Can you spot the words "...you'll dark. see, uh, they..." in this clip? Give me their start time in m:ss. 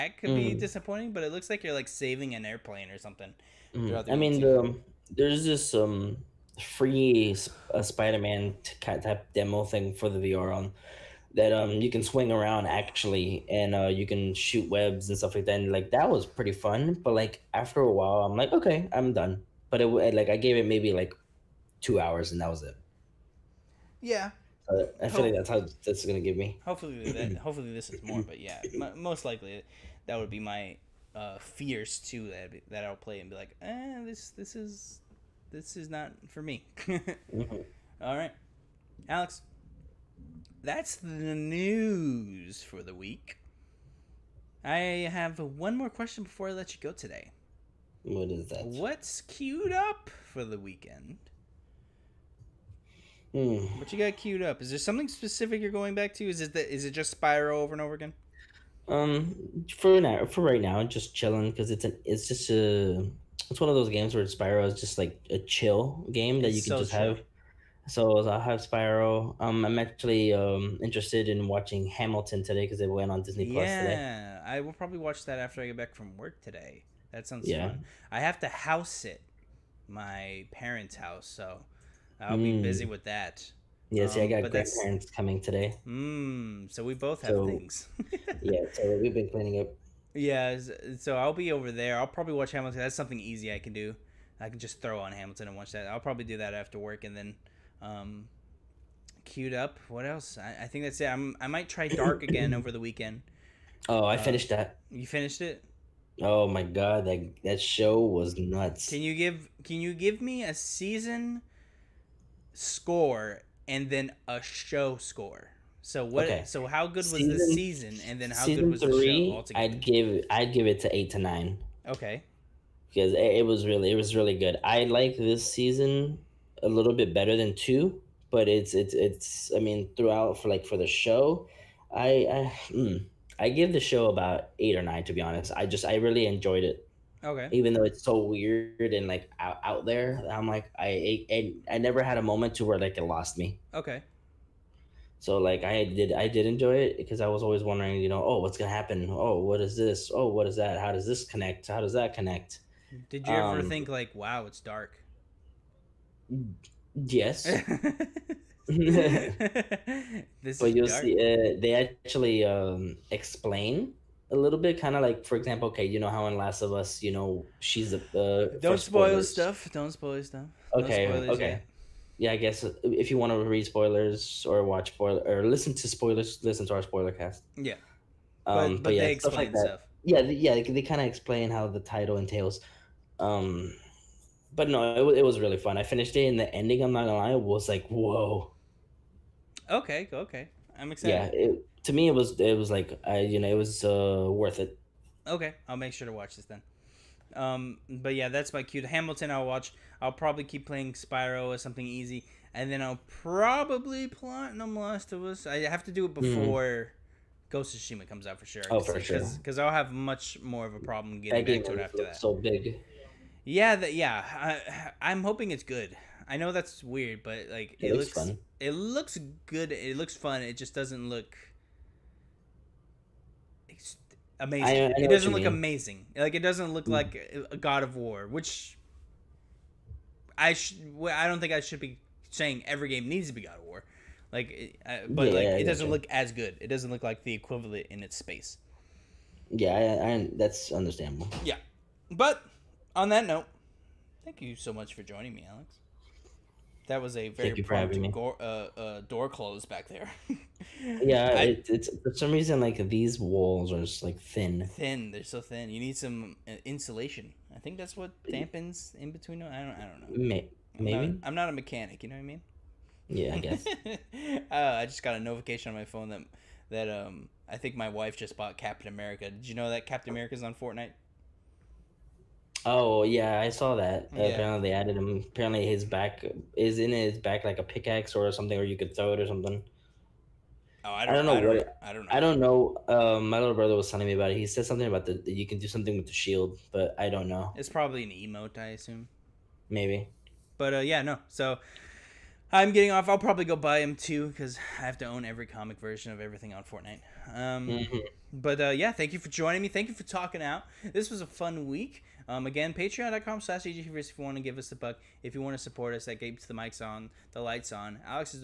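2:38.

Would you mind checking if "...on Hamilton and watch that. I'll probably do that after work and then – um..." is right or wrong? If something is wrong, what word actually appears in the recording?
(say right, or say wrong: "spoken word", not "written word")
right.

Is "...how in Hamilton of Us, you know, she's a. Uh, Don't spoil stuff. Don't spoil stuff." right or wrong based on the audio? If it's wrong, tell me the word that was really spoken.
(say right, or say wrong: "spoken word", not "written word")
wrong: "Last", not "Hamilton".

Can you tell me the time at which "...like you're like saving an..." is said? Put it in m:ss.
0:01.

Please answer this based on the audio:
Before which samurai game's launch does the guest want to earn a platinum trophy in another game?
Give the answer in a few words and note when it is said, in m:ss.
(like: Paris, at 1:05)
Ghost of Tsushima, at 3:27.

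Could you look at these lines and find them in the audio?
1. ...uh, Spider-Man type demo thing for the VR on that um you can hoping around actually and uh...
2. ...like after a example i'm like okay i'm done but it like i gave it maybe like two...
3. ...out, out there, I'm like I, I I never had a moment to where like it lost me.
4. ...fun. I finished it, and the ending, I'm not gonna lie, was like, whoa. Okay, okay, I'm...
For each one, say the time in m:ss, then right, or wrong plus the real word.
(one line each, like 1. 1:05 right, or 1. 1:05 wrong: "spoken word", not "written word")
1. 0:07 wrong: "swing", not "hoping"
2. 0:17 wrong: "while", not "example"
3. 2:19 right
4. 3:05 right.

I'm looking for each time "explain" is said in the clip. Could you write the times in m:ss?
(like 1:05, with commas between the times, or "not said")
2:43, 3:01.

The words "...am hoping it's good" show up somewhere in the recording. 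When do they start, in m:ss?
3:35.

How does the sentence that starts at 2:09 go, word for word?
I mean, throughout for like for the show, I I mm, I give the show about eight or nine to be honest.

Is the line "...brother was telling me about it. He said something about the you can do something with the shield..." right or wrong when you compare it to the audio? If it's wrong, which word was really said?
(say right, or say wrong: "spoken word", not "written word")
right.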